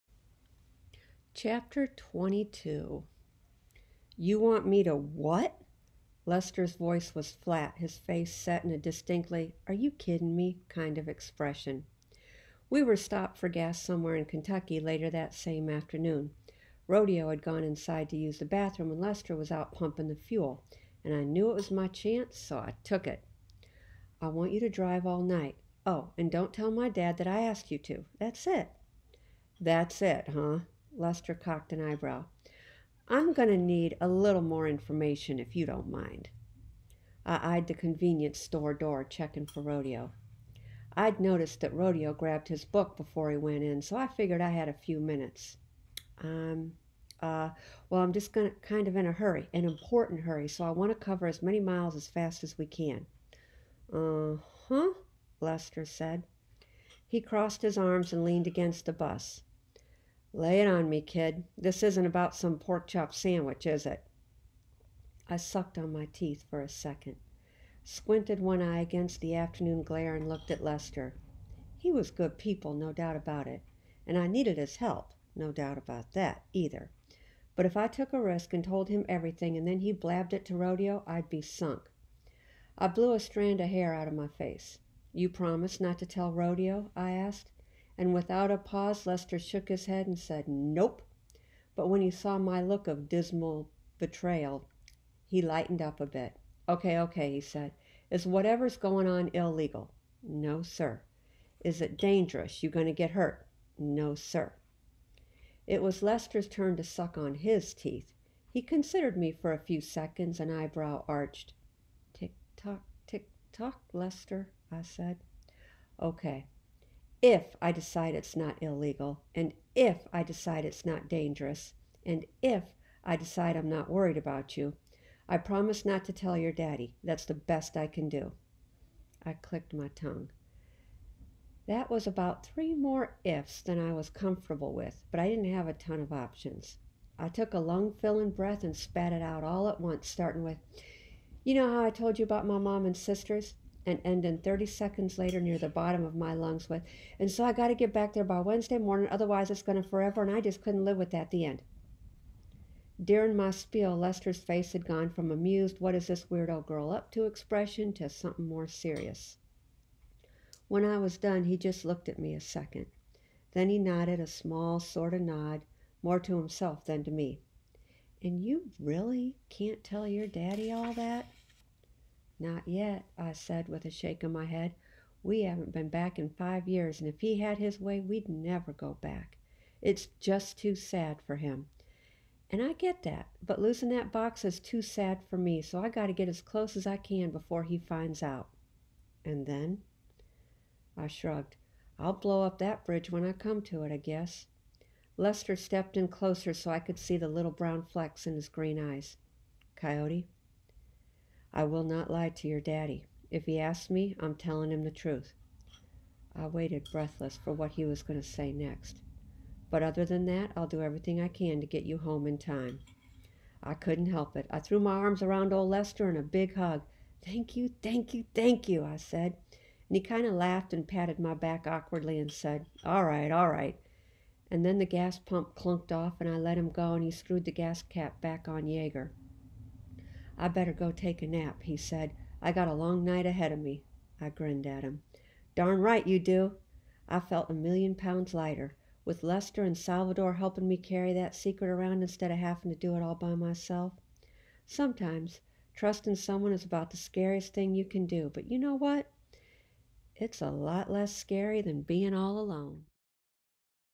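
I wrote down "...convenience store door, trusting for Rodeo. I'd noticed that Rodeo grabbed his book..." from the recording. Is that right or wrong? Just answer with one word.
wrong.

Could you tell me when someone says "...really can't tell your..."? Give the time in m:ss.
2:48.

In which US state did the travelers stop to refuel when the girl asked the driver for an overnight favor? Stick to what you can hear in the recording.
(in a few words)
Kentucky.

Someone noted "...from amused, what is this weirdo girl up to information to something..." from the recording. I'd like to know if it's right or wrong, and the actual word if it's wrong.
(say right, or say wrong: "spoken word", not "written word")
wrong: "expression", not "information".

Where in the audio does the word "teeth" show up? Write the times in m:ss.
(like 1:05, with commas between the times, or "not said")
1:06, 1:47.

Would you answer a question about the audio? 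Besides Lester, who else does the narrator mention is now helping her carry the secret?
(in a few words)
Salvador.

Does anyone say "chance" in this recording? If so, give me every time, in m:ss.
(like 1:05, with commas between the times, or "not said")
0:21.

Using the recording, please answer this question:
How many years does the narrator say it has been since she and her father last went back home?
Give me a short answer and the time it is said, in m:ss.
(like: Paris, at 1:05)
5, at 2:56.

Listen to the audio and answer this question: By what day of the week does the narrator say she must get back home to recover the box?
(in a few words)
Wednesday.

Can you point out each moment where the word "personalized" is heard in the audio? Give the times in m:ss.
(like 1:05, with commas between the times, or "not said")
not said.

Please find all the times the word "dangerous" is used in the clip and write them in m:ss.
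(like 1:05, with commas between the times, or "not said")
1:41, 2:01.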